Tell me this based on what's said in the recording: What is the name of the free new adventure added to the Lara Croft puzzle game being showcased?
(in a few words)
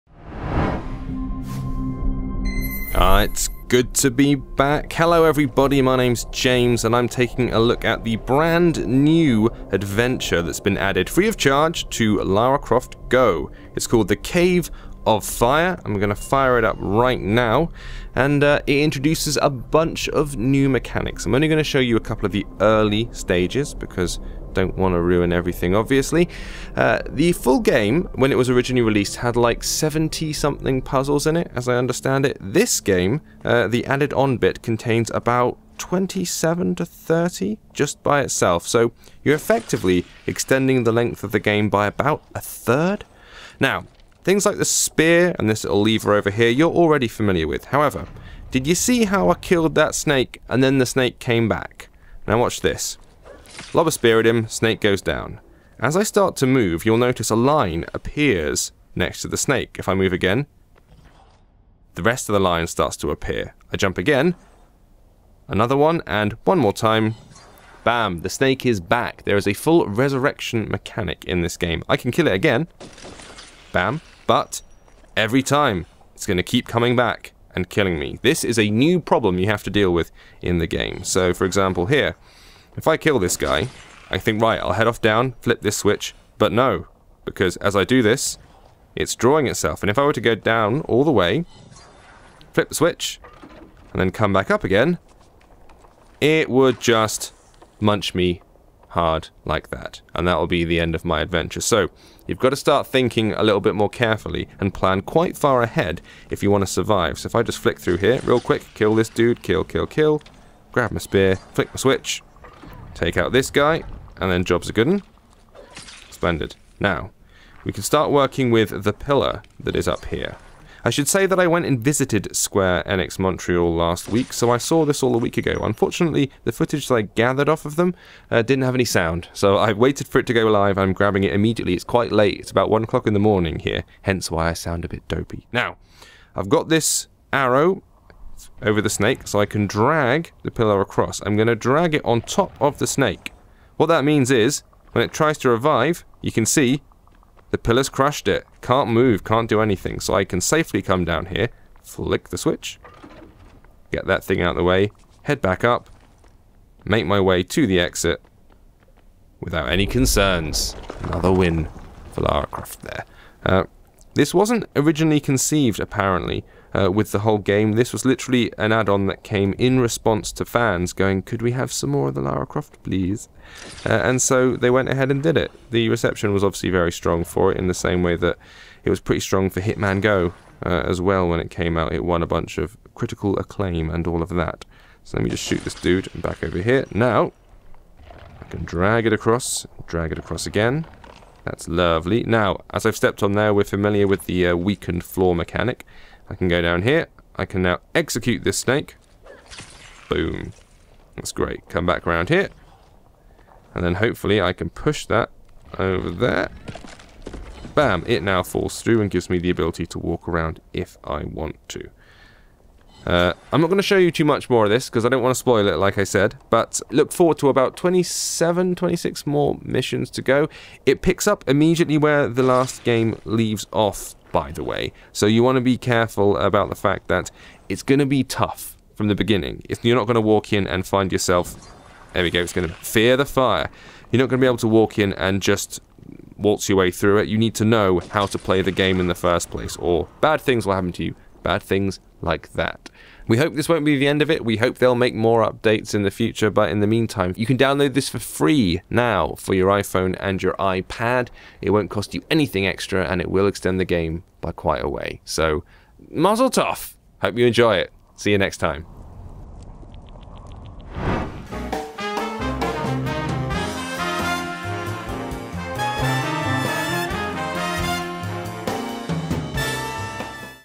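The Cave of Fire.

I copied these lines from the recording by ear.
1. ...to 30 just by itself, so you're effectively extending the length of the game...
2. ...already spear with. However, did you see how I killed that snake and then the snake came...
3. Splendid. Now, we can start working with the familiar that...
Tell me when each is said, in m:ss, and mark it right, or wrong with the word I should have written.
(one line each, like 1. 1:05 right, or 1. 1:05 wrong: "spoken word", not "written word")
1. 0:36 right
2. 0:46 wrong: "familiar", not "spear"
3. 1:56 wrong: "pillar", not "familiar".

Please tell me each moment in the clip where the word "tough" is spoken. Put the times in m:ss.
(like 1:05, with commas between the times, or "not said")
3:48, 4:16.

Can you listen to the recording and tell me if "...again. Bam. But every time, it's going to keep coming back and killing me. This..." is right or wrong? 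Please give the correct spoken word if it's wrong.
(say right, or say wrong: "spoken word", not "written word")
right.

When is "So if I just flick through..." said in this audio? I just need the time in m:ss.
1:47.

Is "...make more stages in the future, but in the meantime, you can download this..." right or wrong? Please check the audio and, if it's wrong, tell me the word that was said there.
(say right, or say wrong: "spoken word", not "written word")
wrong: "updates", not "stages".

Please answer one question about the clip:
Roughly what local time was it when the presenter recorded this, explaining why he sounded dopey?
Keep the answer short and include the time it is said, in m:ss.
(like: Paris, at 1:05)
1 o'clock in the morning, at 2:12.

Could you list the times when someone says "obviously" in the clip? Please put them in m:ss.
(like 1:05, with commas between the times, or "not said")
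0:25, 2:56.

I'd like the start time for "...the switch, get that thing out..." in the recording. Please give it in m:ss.
2:32.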